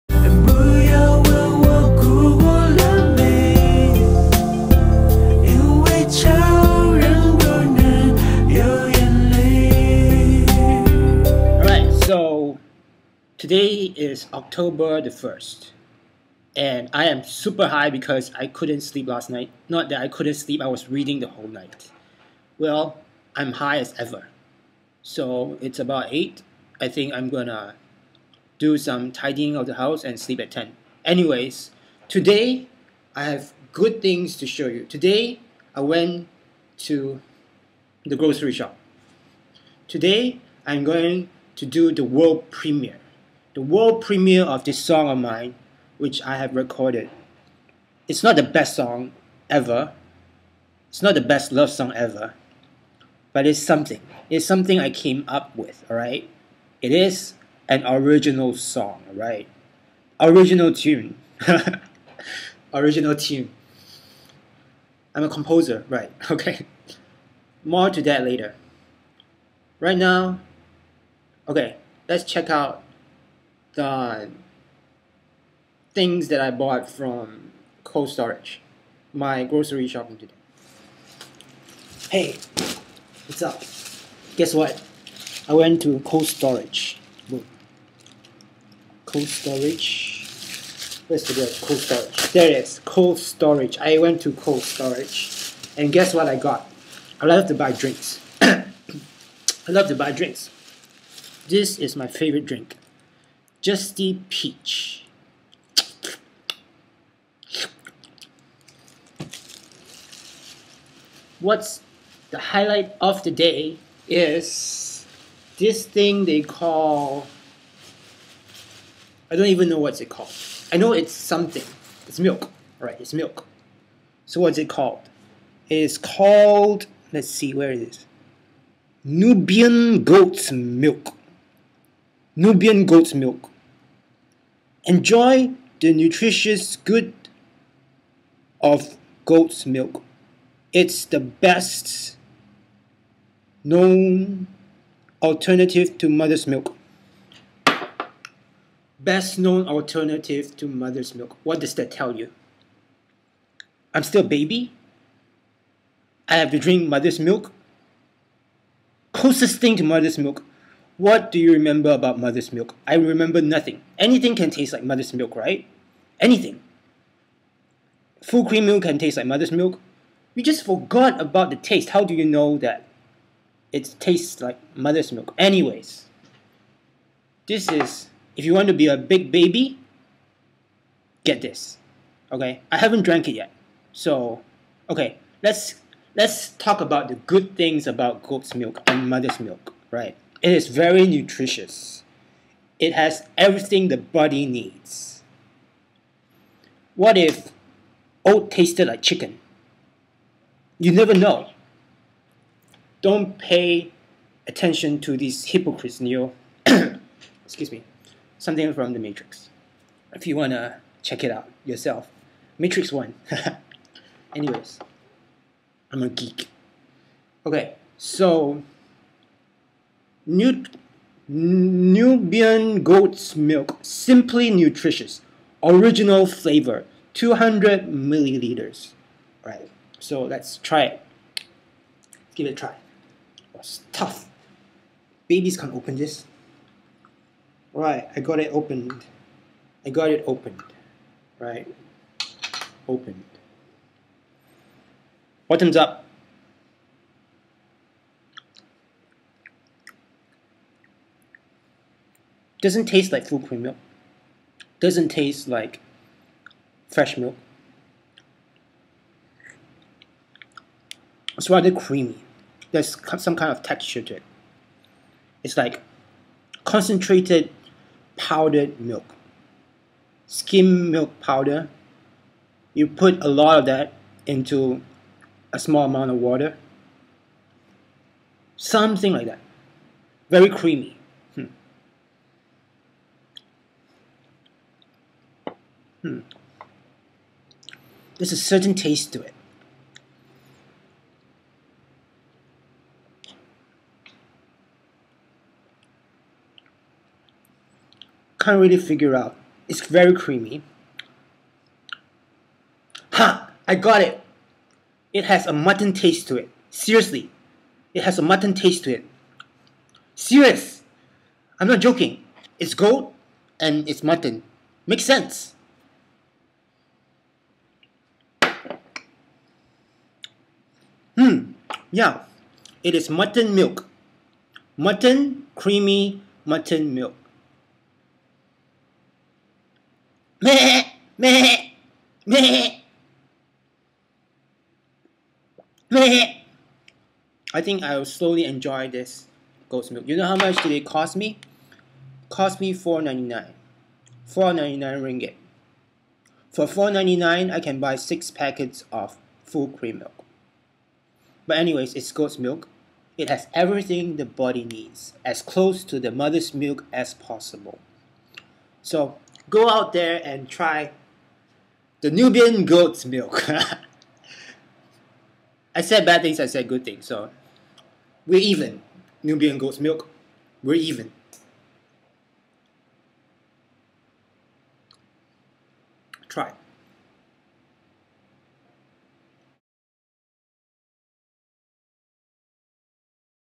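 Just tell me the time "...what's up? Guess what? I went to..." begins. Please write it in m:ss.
1:23.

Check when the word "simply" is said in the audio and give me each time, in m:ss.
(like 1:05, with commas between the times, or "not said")
3:43.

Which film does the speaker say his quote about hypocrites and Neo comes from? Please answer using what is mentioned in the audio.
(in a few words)
Matrix 1.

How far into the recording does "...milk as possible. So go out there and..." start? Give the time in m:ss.
5:56.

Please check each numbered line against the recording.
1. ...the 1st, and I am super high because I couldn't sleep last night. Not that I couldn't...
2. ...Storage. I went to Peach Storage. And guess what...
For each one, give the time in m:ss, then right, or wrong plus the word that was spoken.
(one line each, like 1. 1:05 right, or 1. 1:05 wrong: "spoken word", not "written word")
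1. 0:15 right
2. 1:33 wrong: "Cold", not "Peach".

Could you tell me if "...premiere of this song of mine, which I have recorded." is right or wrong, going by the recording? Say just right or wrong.
right.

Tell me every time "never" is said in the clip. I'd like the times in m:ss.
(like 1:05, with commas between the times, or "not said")
3:20.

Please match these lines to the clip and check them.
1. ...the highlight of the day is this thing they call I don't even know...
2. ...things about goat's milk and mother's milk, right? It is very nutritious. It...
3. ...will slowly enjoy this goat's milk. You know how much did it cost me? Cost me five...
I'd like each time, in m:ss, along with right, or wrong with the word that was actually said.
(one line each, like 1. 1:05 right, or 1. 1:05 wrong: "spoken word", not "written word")
1. 1:52 right
2. 3:07 right
3. 5:37 wrong: "four", not "five".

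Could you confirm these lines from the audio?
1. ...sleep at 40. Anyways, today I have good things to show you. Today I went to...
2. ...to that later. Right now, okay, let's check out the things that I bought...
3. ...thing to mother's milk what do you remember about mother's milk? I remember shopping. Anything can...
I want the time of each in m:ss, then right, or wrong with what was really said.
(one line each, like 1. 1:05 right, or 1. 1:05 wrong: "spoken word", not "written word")
1. 0:30 wrong: "10", not "40"
2. 1:07 right
3. 2:39 wrong: "nothing", not "shopping".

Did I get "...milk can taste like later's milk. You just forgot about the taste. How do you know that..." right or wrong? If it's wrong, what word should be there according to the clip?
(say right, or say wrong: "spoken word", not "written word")
wrong: "mother", not "later".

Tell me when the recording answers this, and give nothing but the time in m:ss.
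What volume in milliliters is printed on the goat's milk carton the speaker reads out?
3:47.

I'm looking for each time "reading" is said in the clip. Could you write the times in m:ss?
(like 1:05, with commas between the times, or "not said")
0:20.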